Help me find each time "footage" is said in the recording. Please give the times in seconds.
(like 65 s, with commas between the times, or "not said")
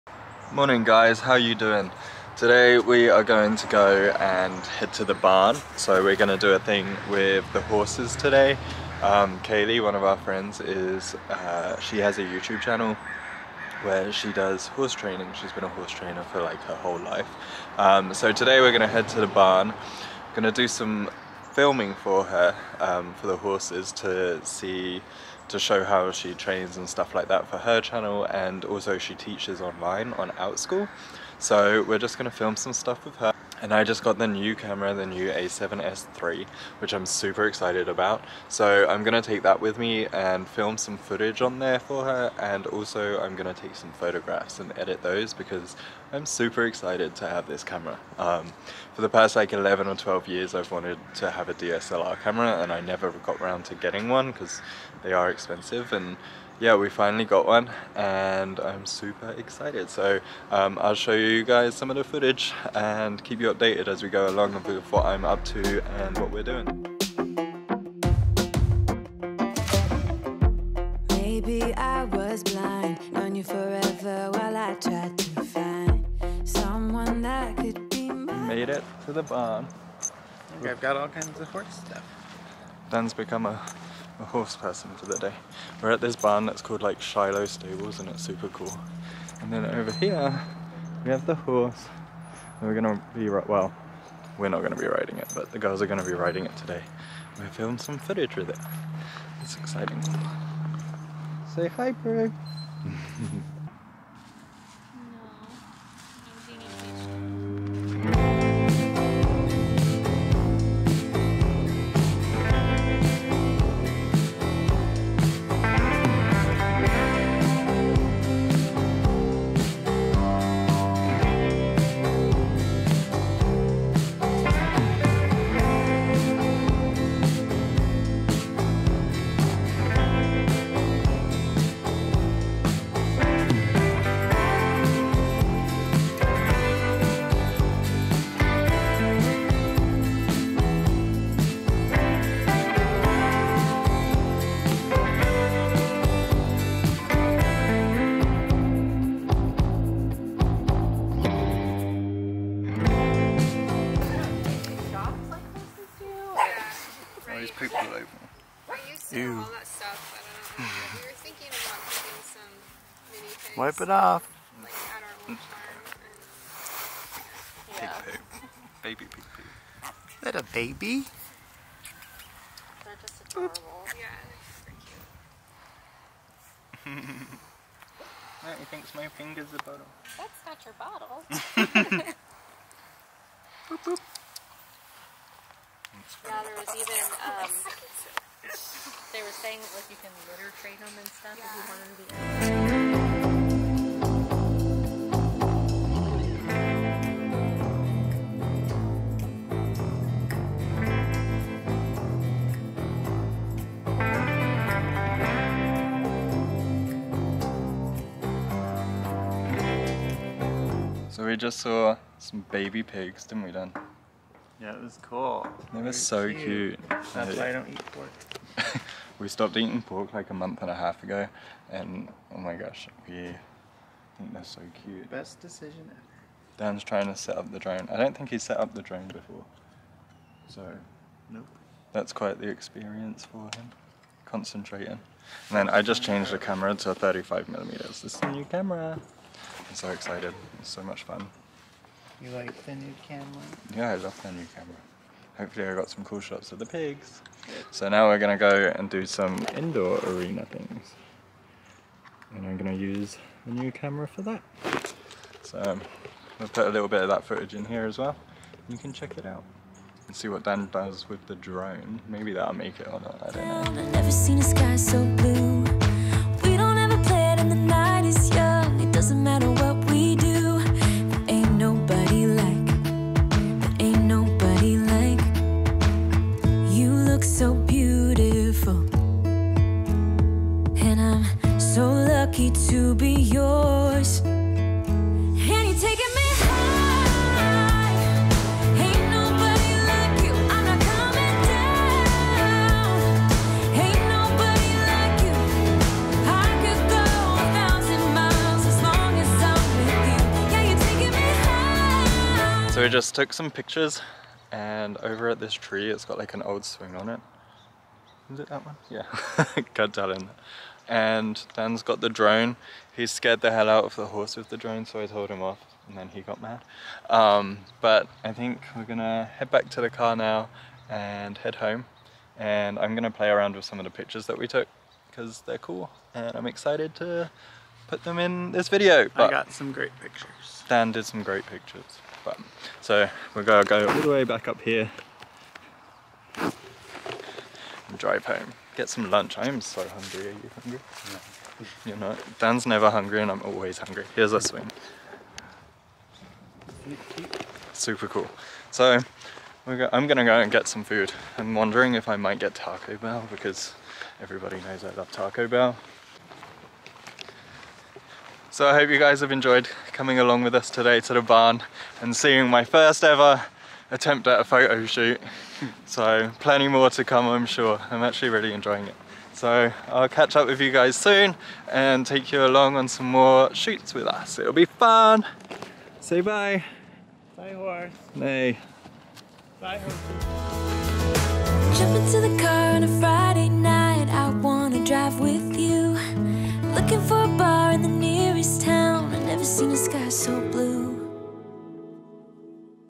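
40 s, 62 s, 97 s, 257 s.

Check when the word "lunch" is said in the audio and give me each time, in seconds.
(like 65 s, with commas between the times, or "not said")
339 s.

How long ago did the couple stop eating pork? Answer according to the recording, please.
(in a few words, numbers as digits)
a month and a half.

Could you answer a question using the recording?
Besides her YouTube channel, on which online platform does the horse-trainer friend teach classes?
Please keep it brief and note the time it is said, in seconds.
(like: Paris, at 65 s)
Outschool, at 30 s.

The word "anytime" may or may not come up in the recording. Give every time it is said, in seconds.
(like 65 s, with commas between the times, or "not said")
not said.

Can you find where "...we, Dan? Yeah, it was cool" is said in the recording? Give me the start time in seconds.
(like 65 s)
213 s.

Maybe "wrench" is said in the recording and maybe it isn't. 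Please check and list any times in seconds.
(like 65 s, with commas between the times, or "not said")
not said.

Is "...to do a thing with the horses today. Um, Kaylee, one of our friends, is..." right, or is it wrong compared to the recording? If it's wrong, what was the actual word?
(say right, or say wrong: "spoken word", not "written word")
right.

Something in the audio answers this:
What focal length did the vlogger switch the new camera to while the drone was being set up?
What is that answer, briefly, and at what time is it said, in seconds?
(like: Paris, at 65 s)
35 millimeters, at 236 s.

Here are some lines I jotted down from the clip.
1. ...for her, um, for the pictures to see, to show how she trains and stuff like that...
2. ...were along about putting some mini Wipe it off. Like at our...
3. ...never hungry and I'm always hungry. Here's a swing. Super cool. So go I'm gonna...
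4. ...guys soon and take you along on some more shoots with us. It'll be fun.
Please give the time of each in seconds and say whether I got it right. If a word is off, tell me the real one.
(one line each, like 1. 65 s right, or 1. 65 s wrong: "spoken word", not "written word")
1. 21 s wrong: "horses", not "pictures"
2. 161 s wrong: "thinking", not "along"
3. 342 s right
4. 370 s right.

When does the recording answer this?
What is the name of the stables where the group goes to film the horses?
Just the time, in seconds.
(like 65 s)
87 s.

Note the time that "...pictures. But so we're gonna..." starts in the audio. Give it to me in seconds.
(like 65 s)
331 s.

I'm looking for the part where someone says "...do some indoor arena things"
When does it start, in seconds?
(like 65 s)
248 s.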